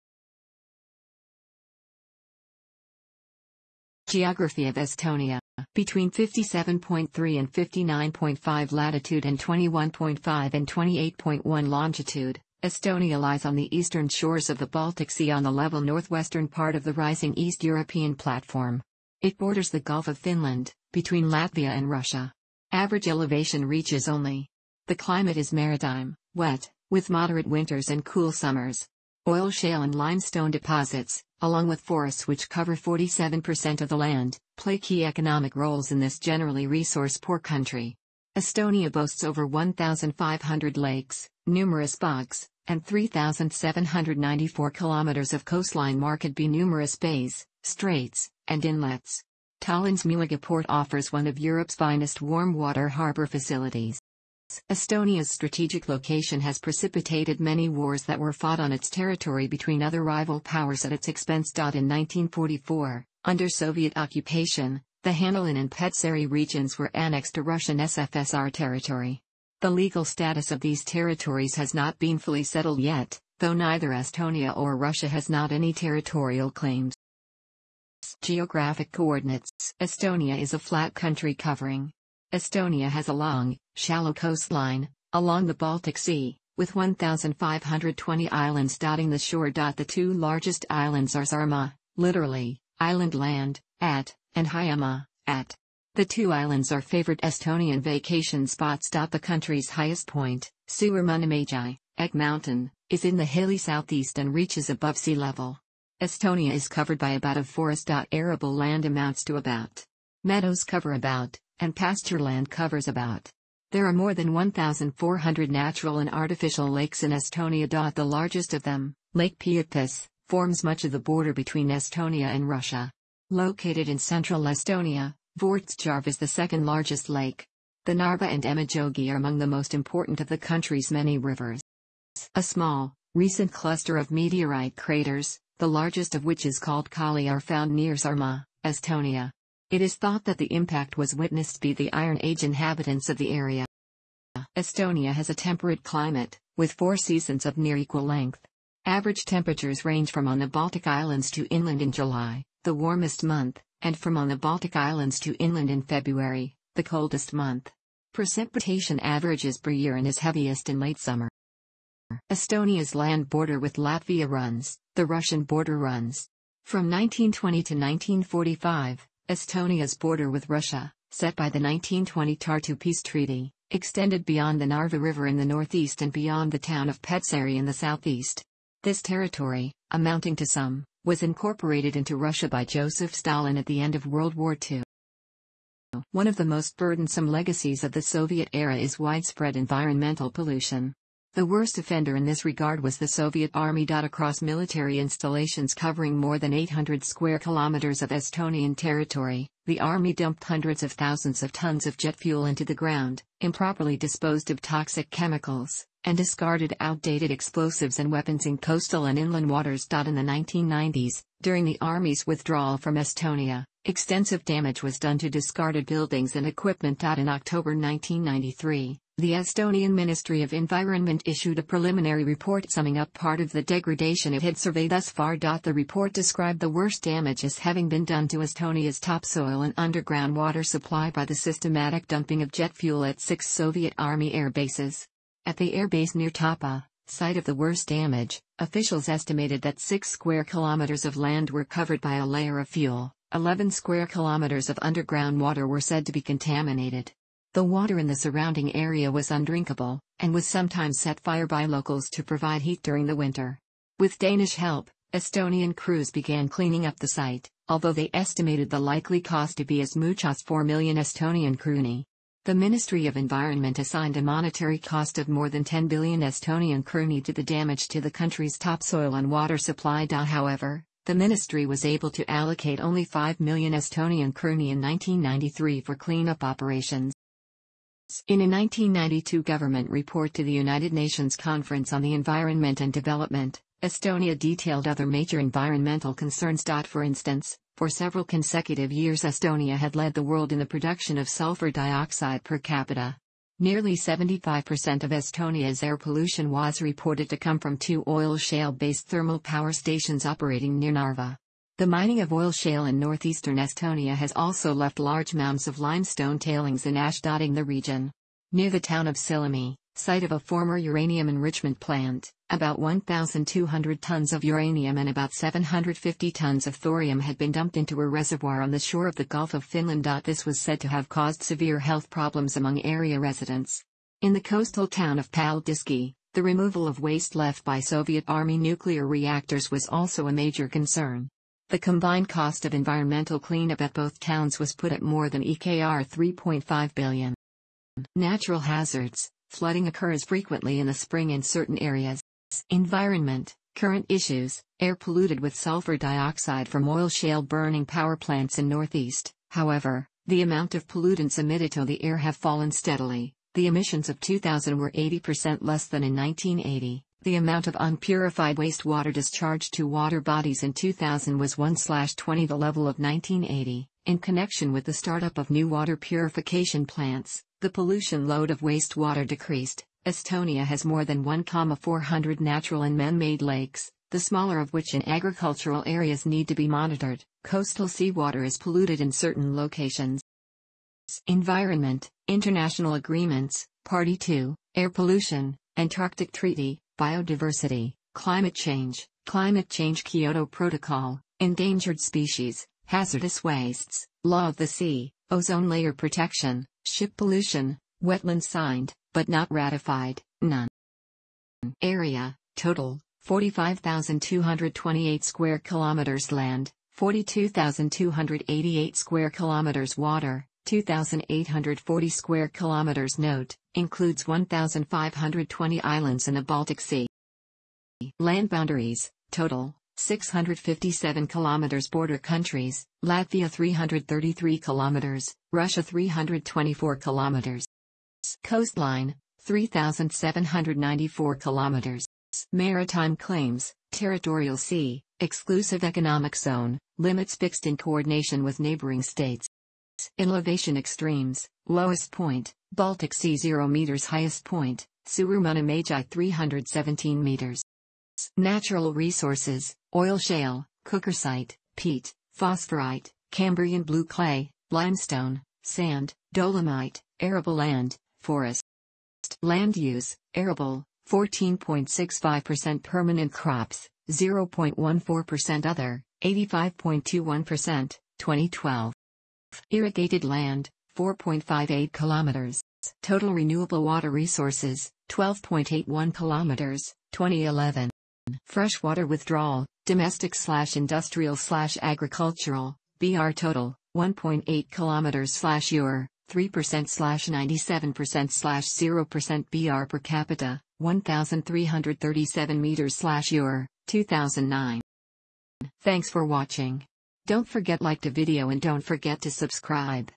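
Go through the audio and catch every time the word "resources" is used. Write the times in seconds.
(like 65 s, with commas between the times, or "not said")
36 s, 448 s, 474 s.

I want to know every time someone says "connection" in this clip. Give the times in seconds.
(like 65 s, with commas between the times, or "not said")
364 s.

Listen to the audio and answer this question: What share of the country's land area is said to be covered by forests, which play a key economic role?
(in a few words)
47%.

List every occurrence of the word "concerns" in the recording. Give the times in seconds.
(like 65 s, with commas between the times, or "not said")
286 s, 330 s.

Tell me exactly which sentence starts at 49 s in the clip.
Tallinn's Muuga port offers one of Europe's finest warm water harbor facilities.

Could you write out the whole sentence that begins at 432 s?
Maritime claims, territorial sea, exclusive economic zone, limits fixed in coordination with neighboring states.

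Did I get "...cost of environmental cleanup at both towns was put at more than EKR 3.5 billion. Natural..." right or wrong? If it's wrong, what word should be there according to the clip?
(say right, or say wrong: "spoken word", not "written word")
right.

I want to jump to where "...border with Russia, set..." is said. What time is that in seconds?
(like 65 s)
169 s.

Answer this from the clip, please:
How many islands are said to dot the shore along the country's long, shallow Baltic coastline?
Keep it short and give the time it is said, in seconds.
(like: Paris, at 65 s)
1,520, at 86 s.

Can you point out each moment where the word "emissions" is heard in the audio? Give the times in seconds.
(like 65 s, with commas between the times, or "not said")
353 s.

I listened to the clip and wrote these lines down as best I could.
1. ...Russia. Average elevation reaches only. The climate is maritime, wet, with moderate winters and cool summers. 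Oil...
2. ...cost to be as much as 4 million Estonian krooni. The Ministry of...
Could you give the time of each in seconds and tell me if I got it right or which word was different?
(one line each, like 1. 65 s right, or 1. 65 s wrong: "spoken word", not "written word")
1. 21 s right
2. 259 s right.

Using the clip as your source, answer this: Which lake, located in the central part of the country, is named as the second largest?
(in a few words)
Vortsjarv.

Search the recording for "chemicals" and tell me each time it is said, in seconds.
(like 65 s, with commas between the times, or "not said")
205 s.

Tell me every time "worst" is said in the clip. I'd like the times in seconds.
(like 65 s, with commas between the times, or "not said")
191 s, 226 s, 237 s.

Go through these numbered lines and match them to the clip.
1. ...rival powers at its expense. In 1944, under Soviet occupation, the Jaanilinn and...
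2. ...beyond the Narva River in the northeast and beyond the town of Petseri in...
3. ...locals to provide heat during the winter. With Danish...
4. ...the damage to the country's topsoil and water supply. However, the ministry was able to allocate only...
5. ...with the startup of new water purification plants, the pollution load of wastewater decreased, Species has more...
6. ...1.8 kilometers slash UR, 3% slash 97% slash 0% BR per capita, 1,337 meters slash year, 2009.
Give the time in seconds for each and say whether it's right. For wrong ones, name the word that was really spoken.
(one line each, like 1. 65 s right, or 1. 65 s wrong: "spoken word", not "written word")
1. 60 s right
2. 174 s right
3. 251 s right
4. 267 s right
5. 364 s wrong: "Estonia", not "Species"
6. 483 s right.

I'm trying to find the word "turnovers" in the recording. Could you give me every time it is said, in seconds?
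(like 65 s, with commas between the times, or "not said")
not said.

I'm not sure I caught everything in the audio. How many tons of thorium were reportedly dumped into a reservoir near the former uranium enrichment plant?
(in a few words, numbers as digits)
750 tons.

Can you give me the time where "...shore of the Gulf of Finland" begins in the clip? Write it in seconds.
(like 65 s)
318 s.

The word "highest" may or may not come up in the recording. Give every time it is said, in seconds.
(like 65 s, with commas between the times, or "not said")
99 s, 444 s.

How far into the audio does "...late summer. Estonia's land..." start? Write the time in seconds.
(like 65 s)
160 s.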